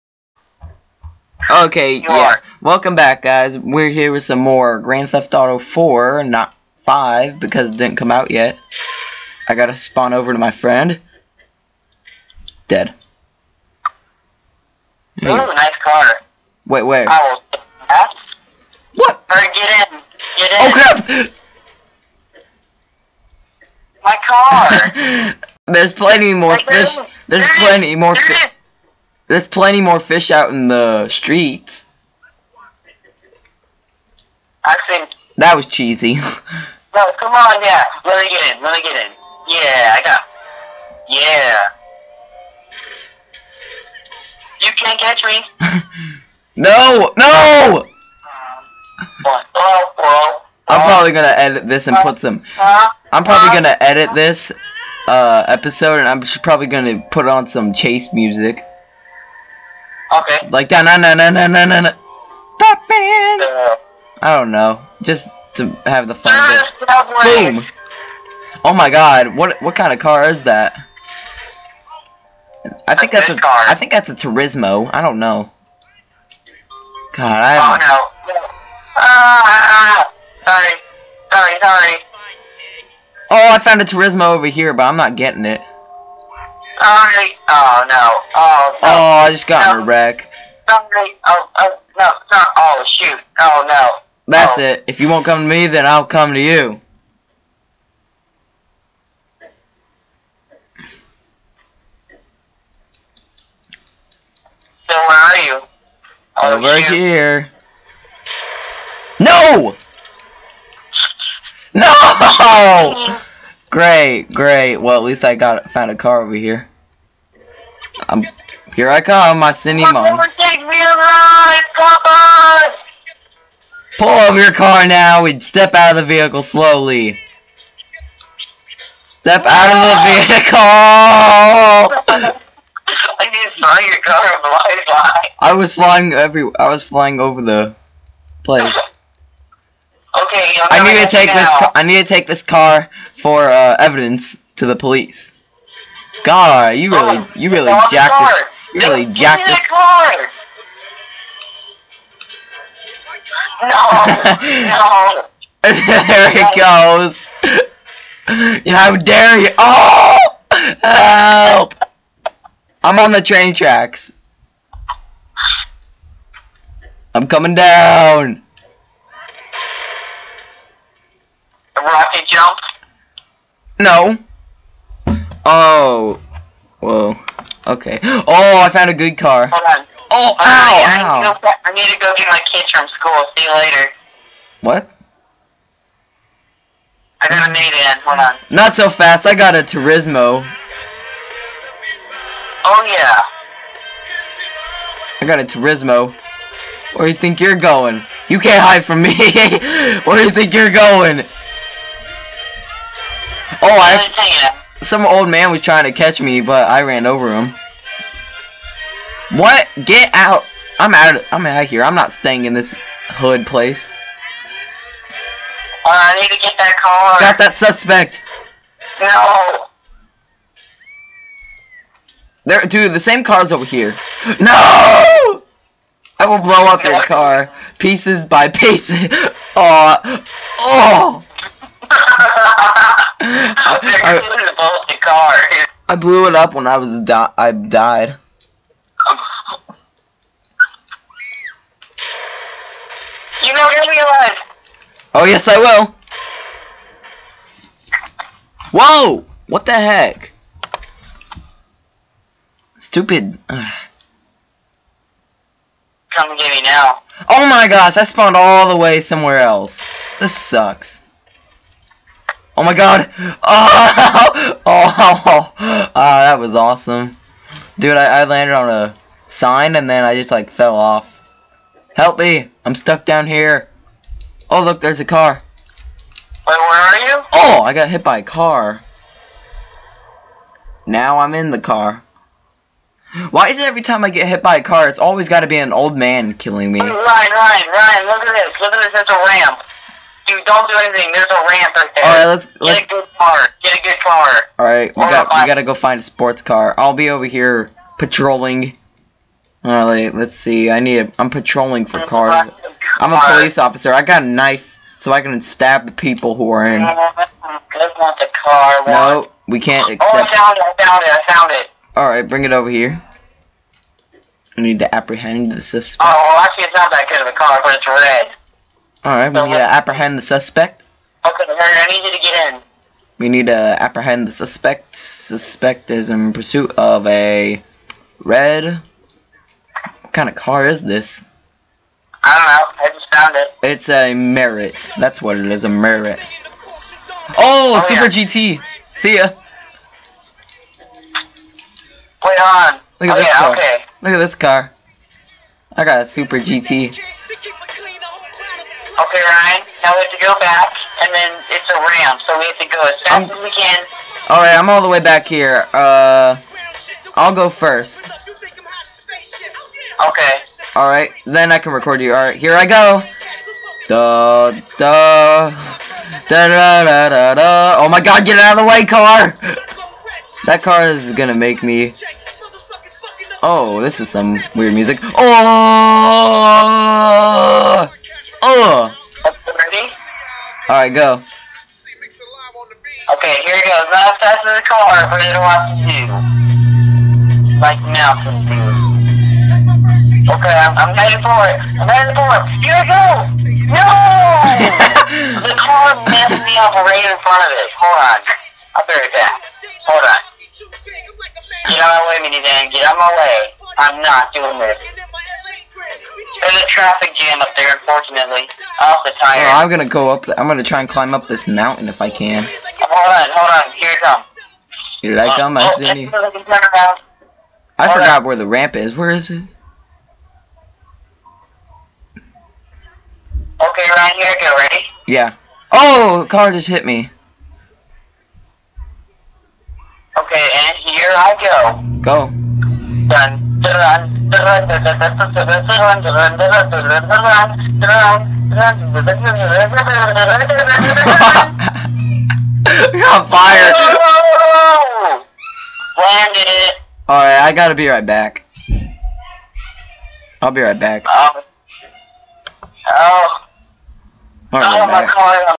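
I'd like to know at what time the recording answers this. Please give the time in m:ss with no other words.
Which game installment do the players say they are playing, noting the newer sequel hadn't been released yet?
0:04.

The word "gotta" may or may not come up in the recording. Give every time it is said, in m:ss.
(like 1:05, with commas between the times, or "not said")
0:09, 4:55, 7:27.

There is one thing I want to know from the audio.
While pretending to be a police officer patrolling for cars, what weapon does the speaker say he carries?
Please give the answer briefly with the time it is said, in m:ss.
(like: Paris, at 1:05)
A knife, at 5:03.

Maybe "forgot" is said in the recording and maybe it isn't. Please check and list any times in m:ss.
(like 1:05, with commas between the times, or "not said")
6:57.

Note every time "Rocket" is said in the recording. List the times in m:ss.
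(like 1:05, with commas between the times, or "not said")
2:51.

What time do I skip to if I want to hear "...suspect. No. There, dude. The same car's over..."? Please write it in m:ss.
3:37.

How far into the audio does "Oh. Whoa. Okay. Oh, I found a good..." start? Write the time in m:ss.
2:55.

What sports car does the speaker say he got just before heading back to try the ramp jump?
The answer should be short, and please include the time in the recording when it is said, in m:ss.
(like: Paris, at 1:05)
Super GT, at 5:45.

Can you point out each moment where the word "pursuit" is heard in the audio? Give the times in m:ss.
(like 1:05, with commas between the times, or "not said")
5:26.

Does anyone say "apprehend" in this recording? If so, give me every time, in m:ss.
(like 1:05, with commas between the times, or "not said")
5:14, 5:19, 5:23.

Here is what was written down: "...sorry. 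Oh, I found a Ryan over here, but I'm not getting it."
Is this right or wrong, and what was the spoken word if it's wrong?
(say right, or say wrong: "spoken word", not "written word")
wrong: "Turismo", not "Ryan".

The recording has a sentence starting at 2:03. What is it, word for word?
Pull over your car now We'd step out of the vehicle slowly.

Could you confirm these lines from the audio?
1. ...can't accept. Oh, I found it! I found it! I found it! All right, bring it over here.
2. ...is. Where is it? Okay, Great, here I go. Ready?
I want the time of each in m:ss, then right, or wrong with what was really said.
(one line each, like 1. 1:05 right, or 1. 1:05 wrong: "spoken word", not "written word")
1. 5:09 right
2. 6:58 wrong: "Ryan", not "Great".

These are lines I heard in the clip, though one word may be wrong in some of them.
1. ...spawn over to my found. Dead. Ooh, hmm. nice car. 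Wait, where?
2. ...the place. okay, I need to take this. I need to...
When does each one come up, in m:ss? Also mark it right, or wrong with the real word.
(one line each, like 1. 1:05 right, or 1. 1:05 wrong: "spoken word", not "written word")
1. 0:09 wrong: "friend", not "found"
2. 2:17 right.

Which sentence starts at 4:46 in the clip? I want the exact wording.
Ryan, Ryan, Ryan, look at this.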